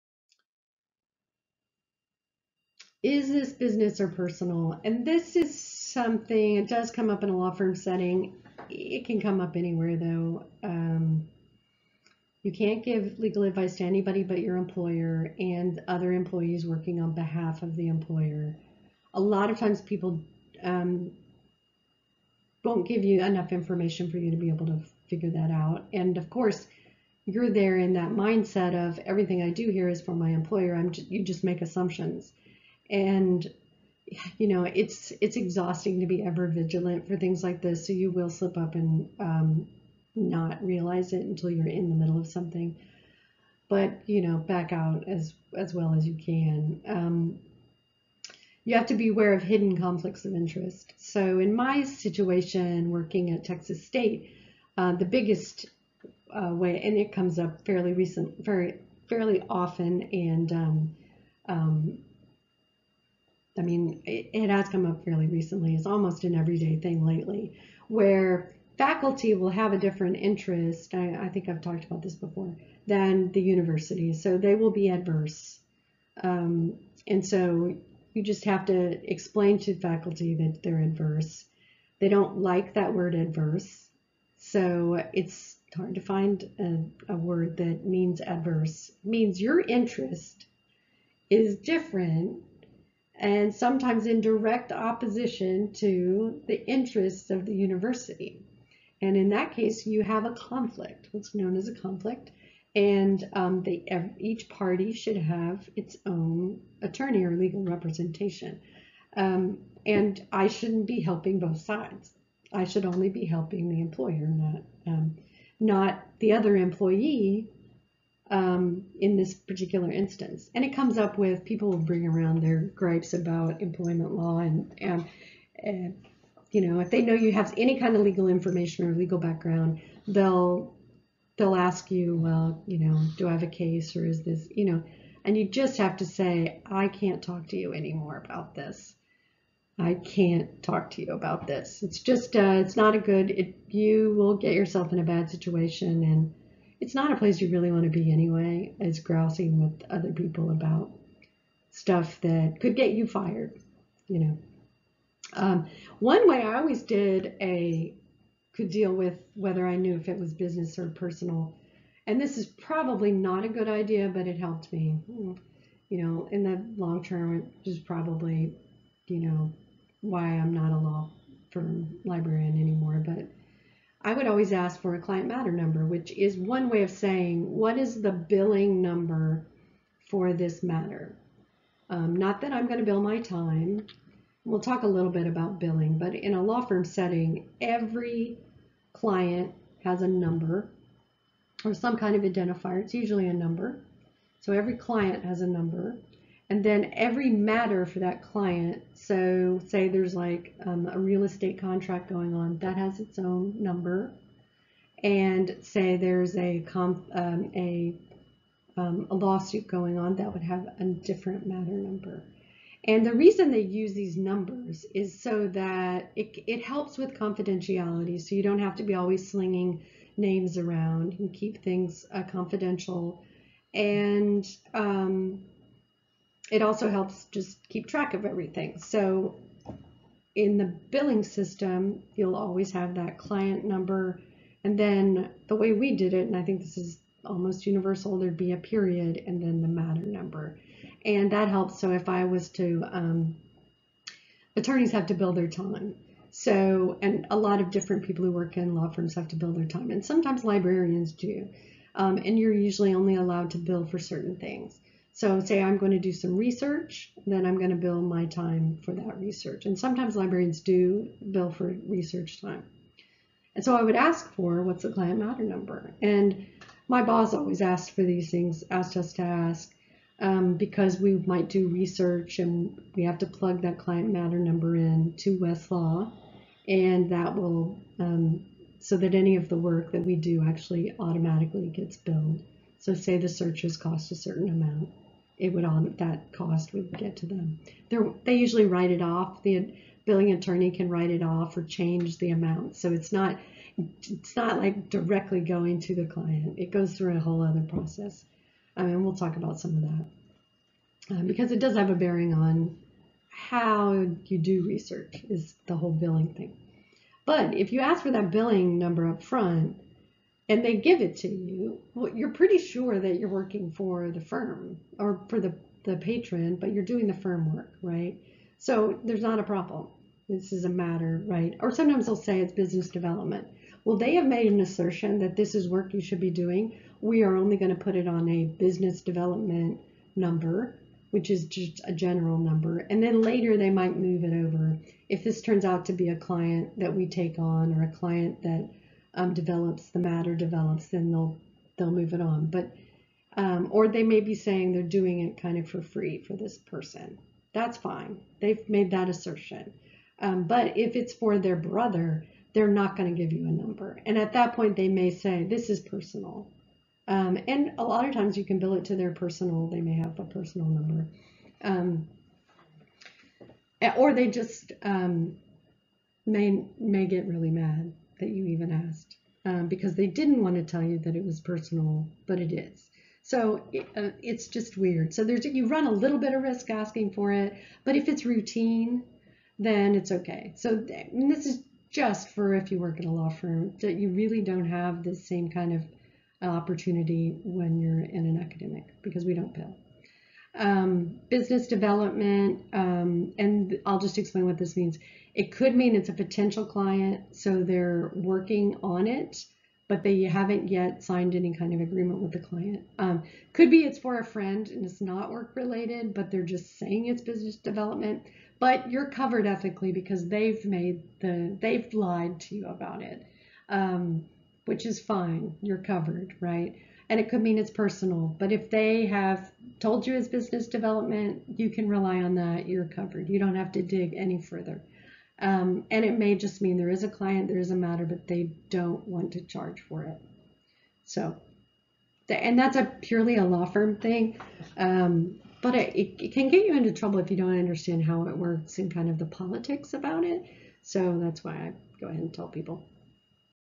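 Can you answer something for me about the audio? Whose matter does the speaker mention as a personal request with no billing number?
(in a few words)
their brother.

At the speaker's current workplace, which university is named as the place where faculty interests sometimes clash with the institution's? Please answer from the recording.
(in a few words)
Texas State.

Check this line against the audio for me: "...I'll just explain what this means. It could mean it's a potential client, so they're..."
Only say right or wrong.
right.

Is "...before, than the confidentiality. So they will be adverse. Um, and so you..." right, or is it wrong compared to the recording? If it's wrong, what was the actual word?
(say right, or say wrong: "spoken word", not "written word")
wrong: "university", not "confidentiality".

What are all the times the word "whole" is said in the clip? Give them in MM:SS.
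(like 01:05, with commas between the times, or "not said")
04:57, 05:05.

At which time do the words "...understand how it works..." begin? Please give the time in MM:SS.
07:17.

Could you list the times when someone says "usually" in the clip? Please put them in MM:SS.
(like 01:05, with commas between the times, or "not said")
03:12, 04:12, 04:48.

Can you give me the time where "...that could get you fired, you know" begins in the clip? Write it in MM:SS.
02:32.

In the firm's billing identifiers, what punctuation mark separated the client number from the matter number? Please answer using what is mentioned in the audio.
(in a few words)
period.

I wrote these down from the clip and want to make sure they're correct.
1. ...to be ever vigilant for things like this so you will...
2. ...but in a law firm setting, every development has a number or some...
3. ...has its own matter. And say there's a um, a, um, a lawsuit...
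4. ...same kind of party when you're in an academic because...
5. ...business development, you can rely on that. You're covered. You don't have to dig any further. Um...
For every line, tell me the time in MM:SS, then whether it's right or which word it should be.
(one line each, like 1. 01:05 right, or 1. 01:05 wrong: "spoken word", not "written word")
1. 00:36 right
2. 03:05 wrong: "client", not "development"
3. 03:22 wrong: "number", not "matter"
4. 06:25 wrong: "opportunity", not "party"
5. 07:00 right.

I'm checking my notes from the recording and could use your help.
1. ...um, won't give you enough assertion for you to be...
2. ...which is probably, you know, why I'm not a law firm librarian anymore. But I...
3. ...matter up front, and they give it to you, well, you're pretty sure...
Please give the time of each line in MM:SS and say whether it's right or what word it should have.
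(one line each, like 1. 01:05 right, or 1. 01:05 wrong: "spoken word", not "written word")
1. 00:20 wrong: "information", not "assertion"
2. 02:47 right
3. 05:08 wrong: "number", not "matter".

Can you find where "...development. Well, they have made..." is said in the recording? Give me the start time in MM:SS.
05:22.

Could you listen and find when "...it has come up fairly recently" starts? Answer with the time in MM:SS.
01:04.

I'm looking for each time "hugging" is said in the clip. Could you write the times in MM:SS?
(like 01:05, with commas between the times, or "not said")
not said.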